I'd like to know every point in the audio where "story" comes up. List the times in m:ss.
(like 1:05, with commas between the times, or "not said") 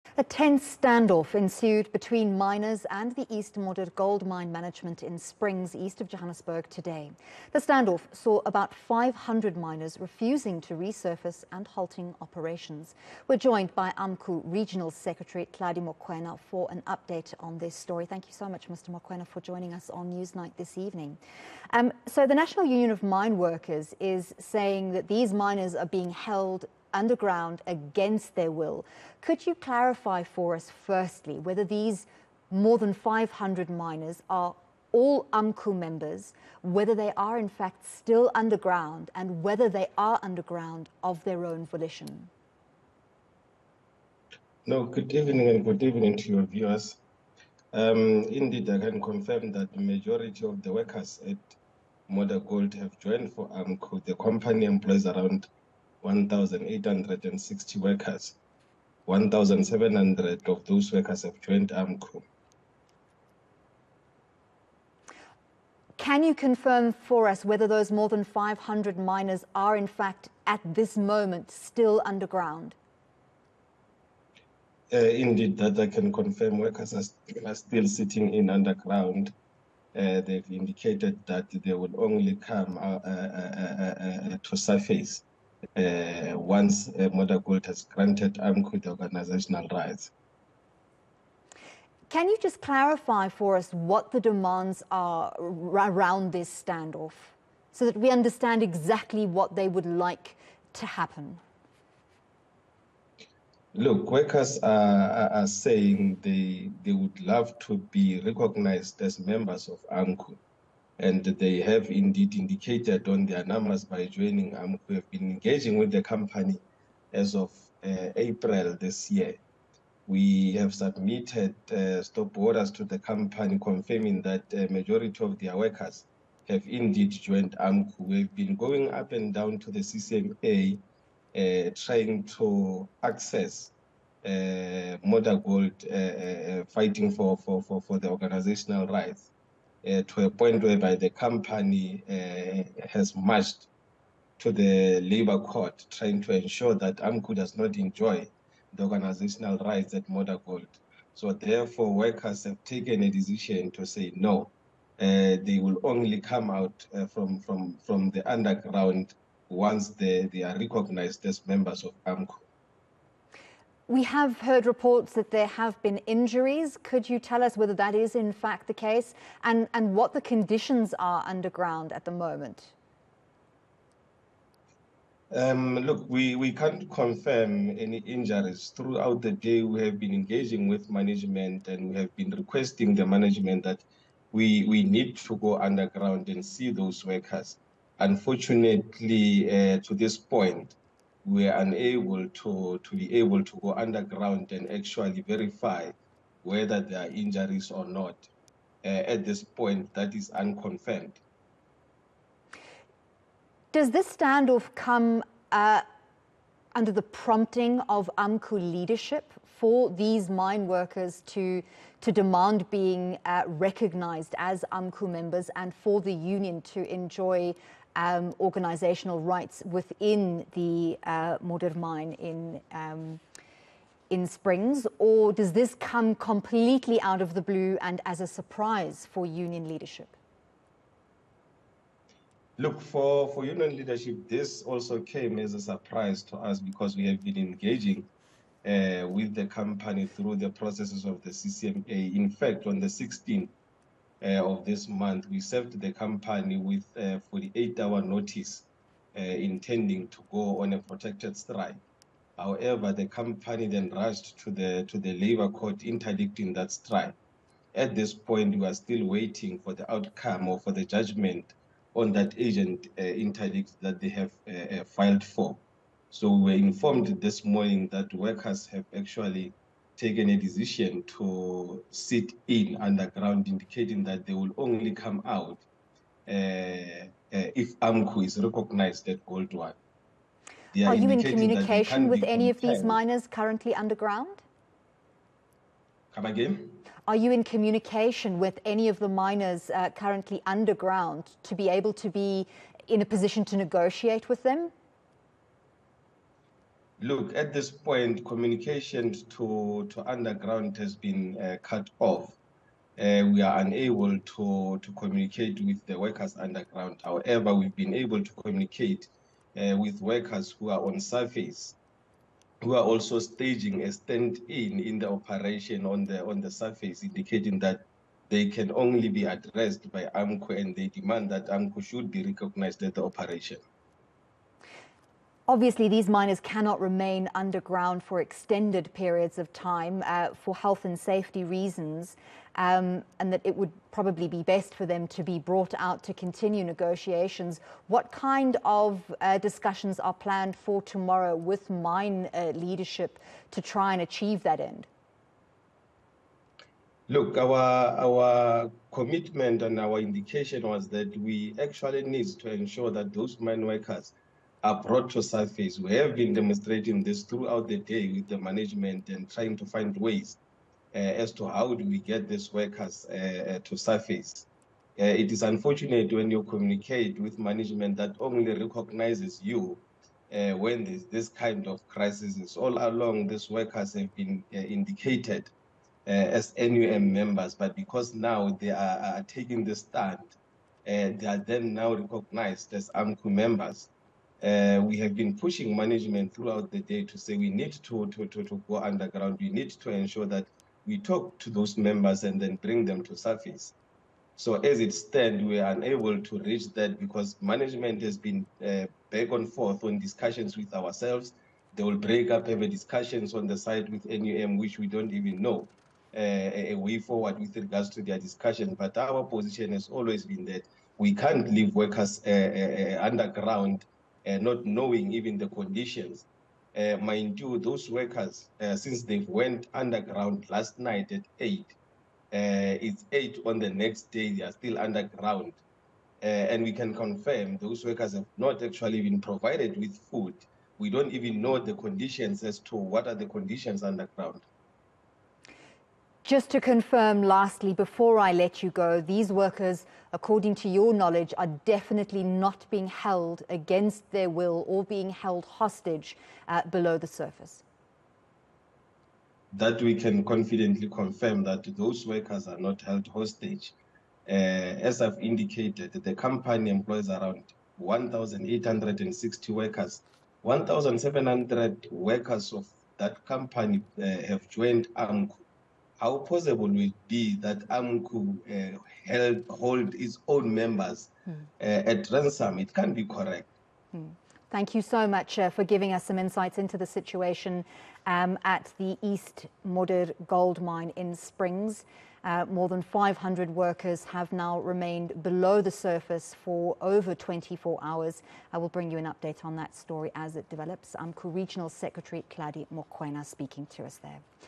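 0:17, 8:09.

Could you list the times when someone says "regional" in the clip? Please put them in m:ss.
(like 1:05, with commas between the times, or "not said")
0:14, 8:10.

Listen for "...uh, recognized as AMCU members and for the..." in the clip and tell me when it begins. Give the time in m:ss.
3:33.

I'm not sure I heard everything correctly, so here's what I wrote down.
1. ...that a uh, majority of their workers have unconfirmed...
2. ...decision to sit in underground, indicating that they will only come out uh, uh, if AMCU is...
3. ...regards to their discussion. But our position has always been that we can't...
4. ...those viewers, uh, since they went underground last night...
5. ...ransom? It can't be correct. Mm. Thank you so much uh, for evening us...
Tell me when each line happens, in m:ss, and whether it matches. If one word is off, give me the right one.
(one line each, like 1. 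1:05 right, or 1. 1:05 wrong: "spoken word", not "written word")
1. 2:04 wrong: "indeed", not "unconfirmed"
2. 4:30 right
3. 6:47 right
4. 6:57 wrong: "workers", not "viewers"
5. 7:52 wrong: "giving", not "evening".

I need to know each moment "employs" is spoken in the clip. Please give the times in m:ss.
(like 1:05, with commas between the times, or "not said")
0:54, 7:36.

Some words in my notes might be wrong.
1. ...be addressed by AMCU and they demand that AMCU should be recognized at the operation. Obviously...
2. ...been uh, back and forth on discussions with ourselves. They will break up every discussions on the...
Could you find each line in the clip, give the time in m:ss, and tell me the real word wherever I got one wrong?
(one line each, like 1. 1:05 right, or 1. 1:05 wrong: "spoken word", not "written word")
1. 5:19 right
2. 6:38 right.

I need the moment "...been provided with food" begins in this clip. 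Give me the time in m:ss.
7:09.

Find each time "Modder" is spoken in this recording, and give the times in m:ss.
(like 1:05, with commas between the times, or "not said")
0:03, 0:52, 2:15, 2:30, 7:59.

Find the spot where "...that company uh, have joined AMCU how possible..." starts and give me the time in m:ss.
7:42.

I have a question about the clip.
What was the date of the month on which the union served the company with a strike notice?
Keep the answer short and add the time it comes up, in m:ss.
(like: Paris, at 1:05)
16th, at 4:02.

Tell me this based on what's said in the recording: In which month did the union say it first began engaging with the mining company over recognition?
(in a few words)
April.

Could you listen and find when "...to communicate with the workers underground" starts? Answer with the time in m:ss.
5:04.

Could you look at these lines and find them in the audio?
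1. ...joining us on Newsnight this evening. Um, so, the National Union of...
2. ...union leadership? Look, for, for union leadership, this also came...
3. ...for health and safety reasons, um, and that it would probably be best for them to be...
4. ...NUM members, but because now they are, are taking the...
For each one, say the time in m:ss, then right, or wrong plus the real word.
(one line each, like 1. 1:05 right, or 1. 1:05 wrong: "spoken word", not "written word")
1. 0:19 right
2. 3:49 right
3. 5:30 right
4. 6:16 right.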